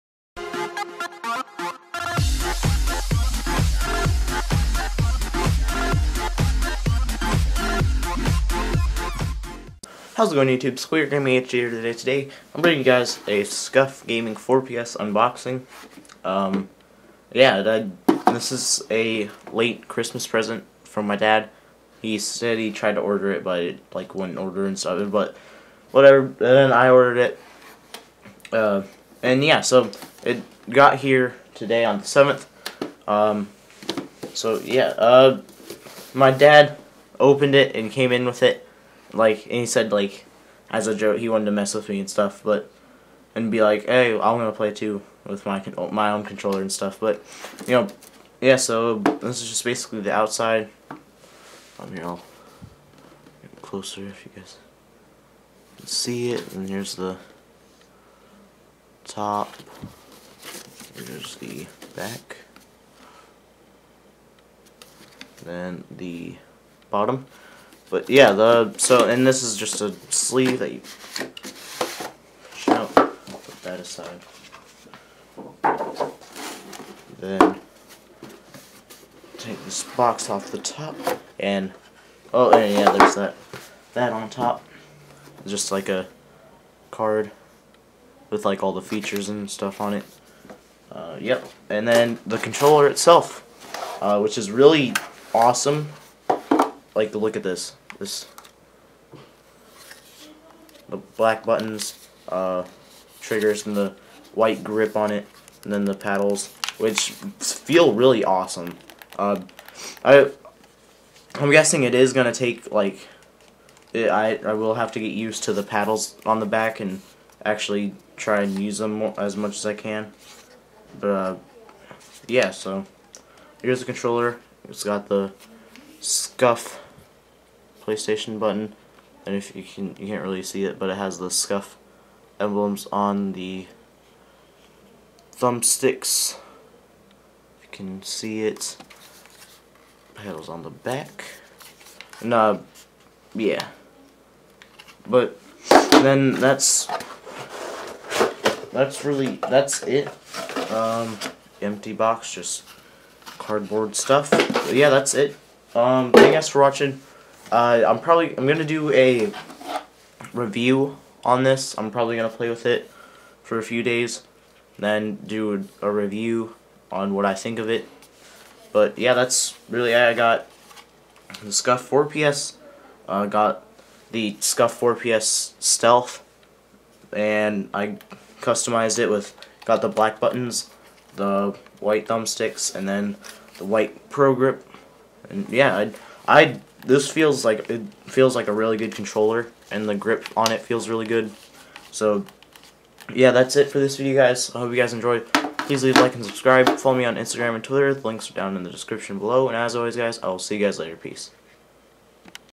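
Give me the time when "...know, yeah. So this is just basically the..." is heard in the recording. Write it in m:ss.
0:47.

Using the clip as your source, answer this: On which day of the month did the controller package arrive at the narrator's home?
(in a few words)
7th.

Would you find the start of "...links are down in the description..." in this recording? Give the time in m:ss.
3:18.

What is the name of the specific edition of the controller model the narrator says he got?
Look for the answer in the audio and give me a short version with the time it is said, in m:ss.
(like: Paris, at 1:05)
Stealth, at 2:55.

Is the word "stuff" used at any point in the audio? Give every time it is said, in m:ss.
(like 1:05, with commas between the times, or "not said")
0:24, 0:42, 0:46, 1:29, 2:33.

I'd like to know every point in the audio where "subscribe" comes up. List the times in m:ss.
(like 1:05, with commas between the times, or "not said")
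3:16.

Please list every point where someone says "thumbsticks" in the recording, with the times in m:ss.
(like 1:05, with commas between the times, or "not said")
2:15, 3:02.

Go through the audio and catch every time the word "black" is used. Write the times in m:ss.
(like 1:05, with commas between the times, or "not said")
1:41, 2:59.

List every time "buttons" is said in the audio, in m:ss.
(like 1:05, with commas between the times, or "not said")
1:41, 2:08, 3:00.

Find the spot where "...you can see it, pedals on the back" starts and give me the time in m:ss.
2:17.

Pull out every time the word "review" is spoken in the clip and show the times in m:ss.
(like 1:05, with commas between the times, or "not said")
2:40, 2:45.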